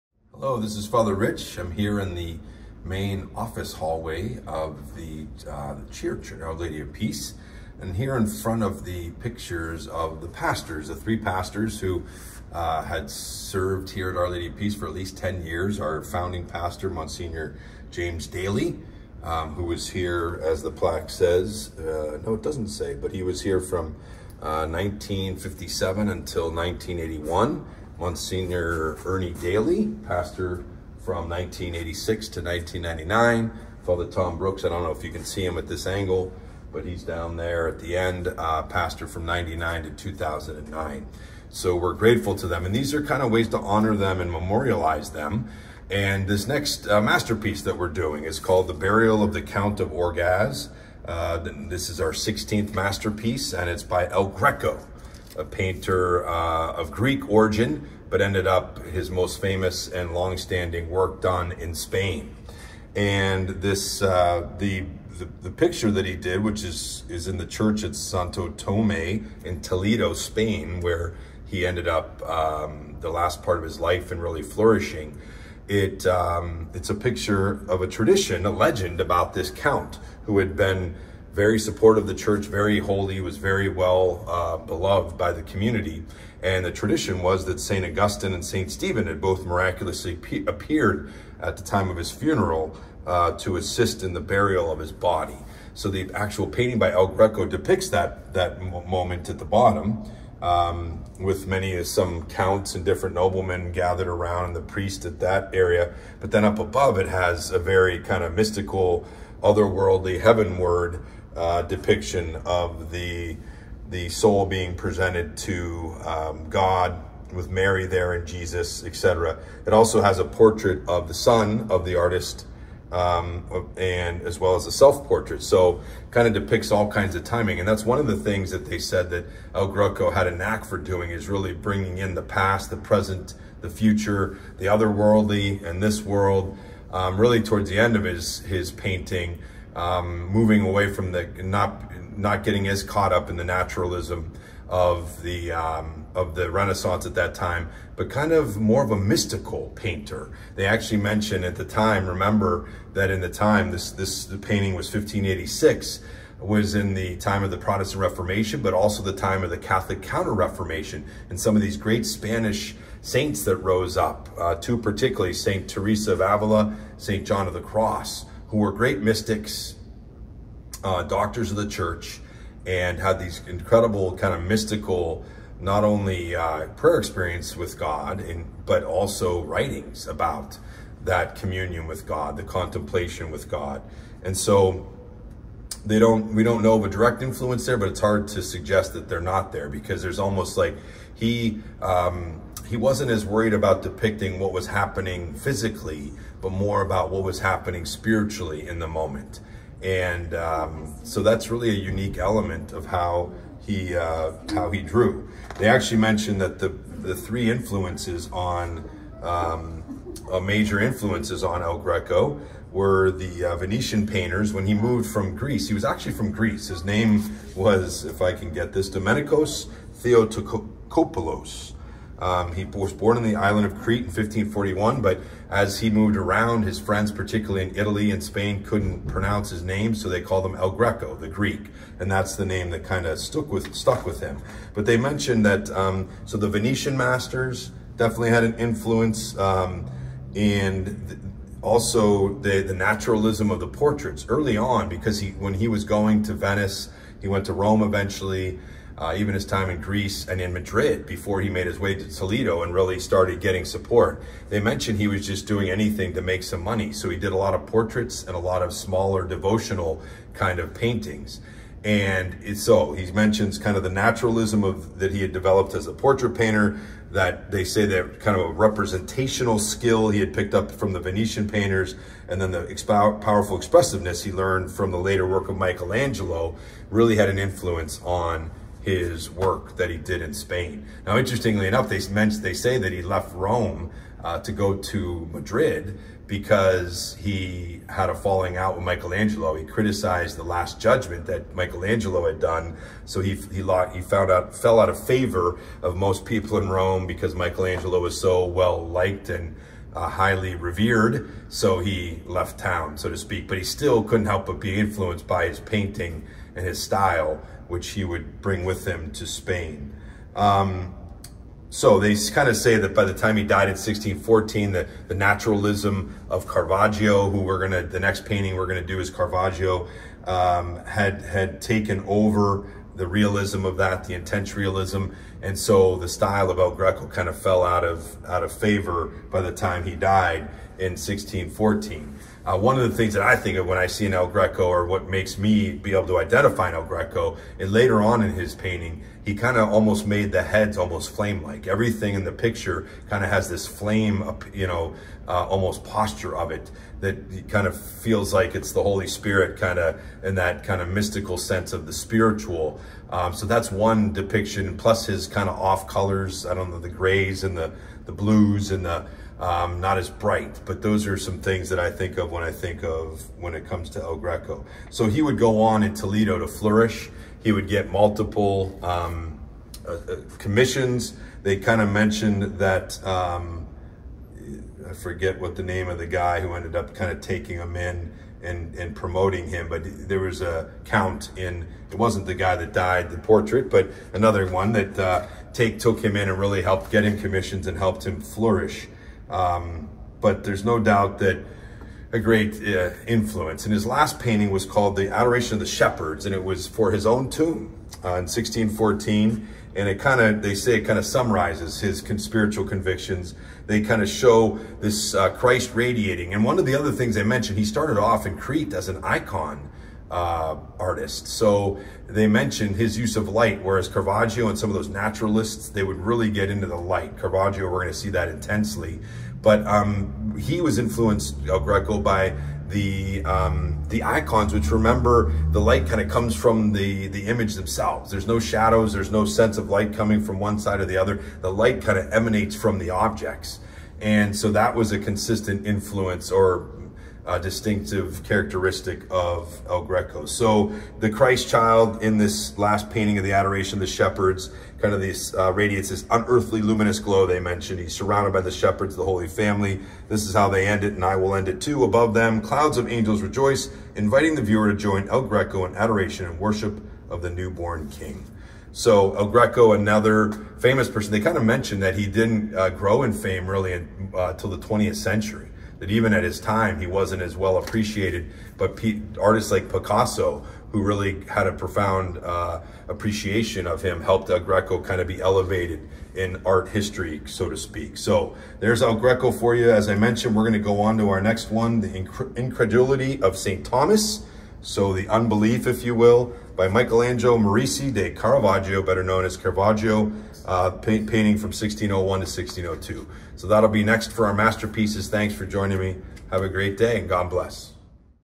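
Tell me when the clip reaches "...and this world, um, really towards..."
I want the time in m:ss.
2:15.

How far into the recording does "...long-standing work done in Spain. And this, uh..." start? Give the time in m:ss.
1:00.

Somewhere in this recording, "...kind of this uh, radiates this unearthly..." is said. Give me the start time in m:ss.
7:24.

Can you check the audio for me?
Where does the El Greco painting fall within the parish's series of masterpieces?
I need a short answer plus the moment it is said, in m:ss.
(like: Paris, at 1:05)
16th, at 0:52.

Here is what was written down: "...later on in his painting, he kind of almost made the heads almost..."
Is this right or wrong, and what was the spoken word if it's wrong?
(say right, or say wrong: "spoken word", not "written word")
right.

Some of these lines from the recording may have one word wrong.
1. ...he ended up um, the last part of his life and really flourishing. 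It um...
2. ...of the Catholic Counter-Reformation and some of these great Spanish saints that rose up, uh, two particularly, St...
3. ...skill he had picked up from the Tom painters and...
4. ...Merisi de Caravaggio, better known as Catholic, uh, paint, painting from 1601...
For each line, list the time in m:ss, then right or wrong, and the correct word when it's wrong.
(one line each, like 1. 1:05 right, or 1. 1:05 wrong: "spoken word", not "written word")
1. 1:11 right
2. 2:39 right
3. 4:29 wrong: "Venetian", not "Tom"
4. 8:07 wrong: "Caravaggio", not "Catholic".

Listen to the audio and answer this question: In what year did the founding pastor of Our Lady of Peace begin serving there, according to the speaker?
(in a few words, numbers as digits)
1957.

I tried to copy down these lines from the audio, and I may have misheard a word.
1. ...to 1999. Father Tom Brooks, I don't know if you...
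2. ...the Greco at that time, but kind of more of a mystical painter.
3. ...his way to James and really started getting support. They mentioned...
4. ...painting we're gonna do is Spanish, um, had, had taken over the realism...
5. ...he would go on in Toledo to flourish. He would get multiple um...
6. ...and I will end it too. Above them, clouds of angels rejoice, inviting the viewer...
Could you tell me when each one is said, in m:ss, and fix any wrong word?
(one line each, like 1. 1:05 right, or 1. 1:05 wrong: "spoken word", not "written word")
1. 0:32 right
2. 2:26 wrong: "Renaissance", not "Greco"
3. 4:11 wrong: "Toledo", not "James"
4. 5:18 wrong: "Caravaggio", not "Spanish"
5. 6:05 right
6. 7:30 right.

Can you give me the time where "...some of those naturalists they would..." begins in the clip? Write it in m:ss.
6:54.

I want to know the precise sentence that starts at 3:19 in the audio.
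And um, so that's really a unique element of how he uh, how he drew.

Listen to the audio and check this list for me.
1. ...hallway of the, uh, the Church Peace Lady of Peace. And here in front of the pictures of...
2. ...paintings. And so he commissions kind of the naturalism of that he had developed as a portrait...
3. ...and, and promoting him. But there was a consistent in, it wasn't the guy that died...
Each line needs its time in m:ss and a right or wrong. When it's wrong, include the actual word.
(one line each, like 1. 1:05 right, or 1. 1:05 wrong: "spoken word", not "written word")
1. 0:03 wrong: "Our", not "Peace"
2. 4:20 wrong: "mentions", not "commissions"
3. 6:18 wrong: "count", not "consistent".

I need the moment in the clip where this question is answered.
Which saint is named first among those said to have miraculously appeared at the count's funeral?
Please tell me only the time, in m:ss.
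1:27.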